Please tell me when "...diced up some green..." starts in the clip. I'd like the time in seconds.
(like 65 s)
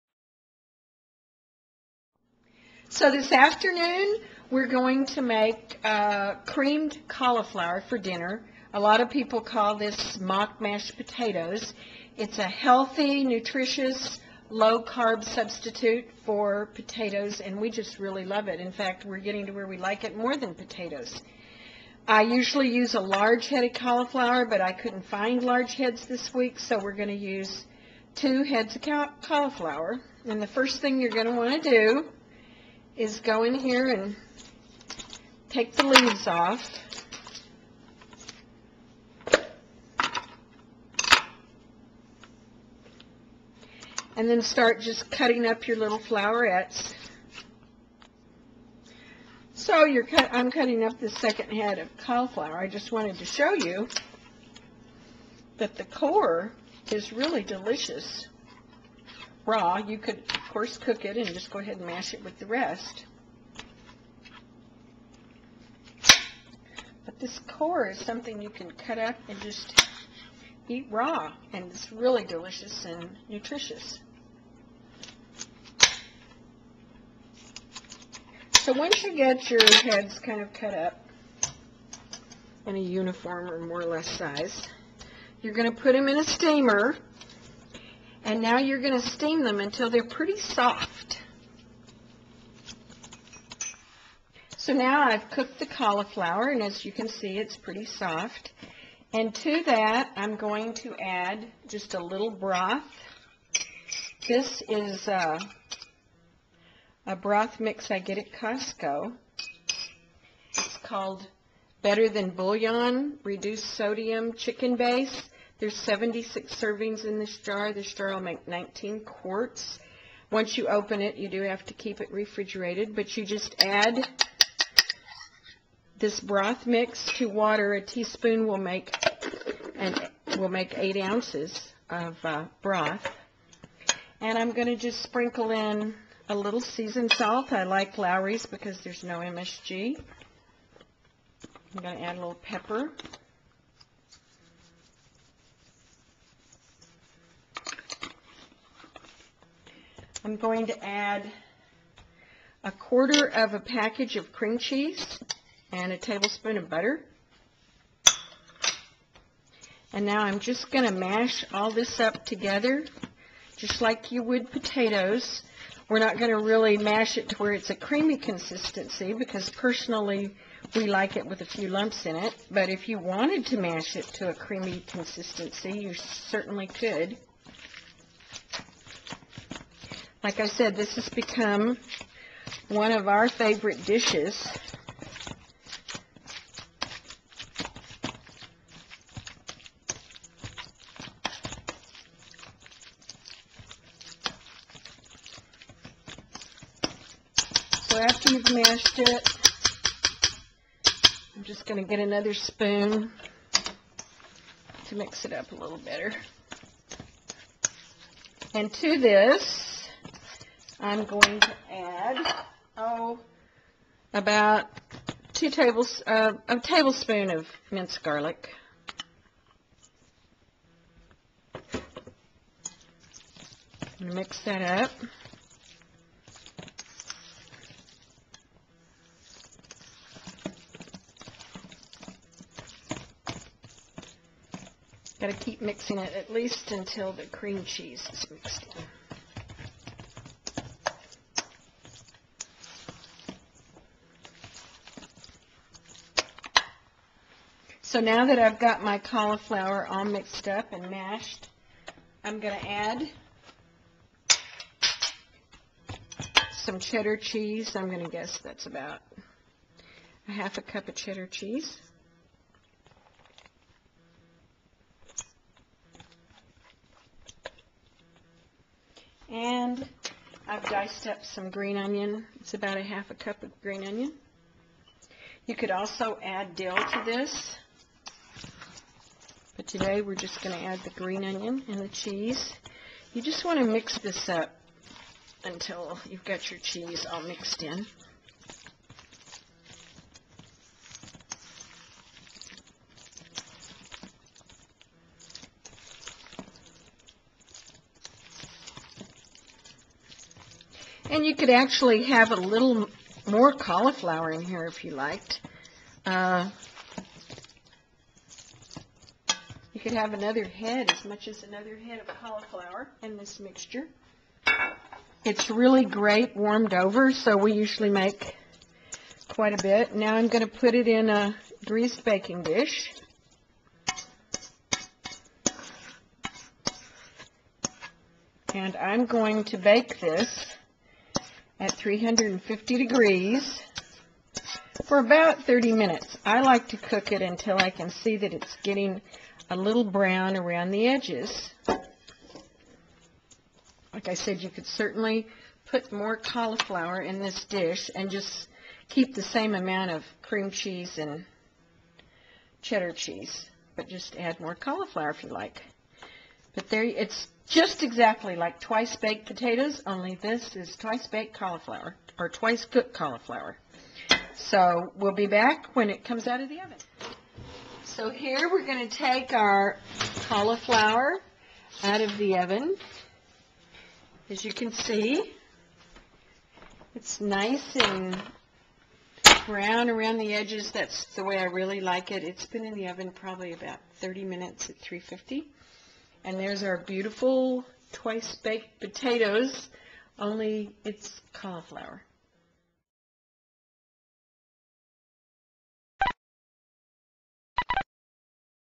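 270 s.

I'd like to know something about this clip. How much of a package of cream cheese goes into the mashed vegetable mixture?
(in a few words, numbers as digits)
a quarter.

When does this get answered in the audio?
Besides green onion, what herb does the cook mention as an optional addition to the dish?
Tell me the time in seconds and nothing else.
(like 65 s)
276 s.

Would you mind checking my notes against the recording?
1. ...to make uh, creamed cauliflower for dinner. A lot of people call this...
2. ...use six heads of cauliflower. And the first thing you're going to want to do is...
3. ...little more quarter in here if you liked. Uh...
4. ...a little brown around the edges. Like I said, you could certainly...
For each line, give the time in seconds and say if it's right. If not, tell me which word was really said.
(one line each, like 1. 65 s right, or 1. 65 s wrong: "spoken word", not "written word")
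1. 5 s right
2. 27 s wrong: "two", not "six"
3. 302 s wrong: "cauliflower", not "quarter"
4. 339 s right.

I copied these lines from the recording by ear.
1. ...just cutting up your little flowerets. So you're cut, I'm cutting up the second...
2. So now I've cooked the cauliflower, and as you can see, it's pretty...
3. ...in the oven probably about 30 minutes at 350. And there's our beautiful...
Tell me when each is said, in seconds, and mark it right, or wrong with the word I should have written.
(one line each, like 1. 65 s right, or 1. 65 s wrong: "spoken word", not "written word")
1. 44 s right
2. 94 s right
3. 382 s right.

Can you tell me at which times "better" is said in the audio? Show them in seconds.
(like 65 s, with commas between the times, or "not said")
111 s, 205 s.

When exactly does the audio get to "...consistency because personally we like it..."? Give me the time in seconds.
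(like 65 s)
168 s.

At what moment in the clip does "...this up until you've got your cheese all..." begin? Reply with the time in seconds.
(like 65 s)
283 s.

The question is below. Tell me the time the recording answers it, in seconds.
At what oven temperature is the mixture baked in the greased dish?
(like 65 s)
331 s.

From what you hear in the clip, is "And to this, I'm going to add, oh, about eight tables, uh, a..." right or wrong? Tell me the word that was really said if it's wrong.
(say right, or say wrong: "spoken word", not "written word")
wrong: "two", not "eight".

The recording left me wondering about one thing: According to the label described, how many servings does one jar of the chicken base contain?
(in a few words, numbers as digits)
76.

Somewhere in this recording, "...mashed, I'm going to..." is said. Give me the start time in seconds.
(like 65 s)
250 s.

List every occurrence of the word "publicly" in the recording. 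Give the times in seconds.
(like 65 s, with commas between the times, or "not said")
not said.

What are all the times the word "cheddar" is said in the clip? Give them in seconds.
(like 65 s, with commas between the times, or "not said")
256 s, 260 s, 352 s.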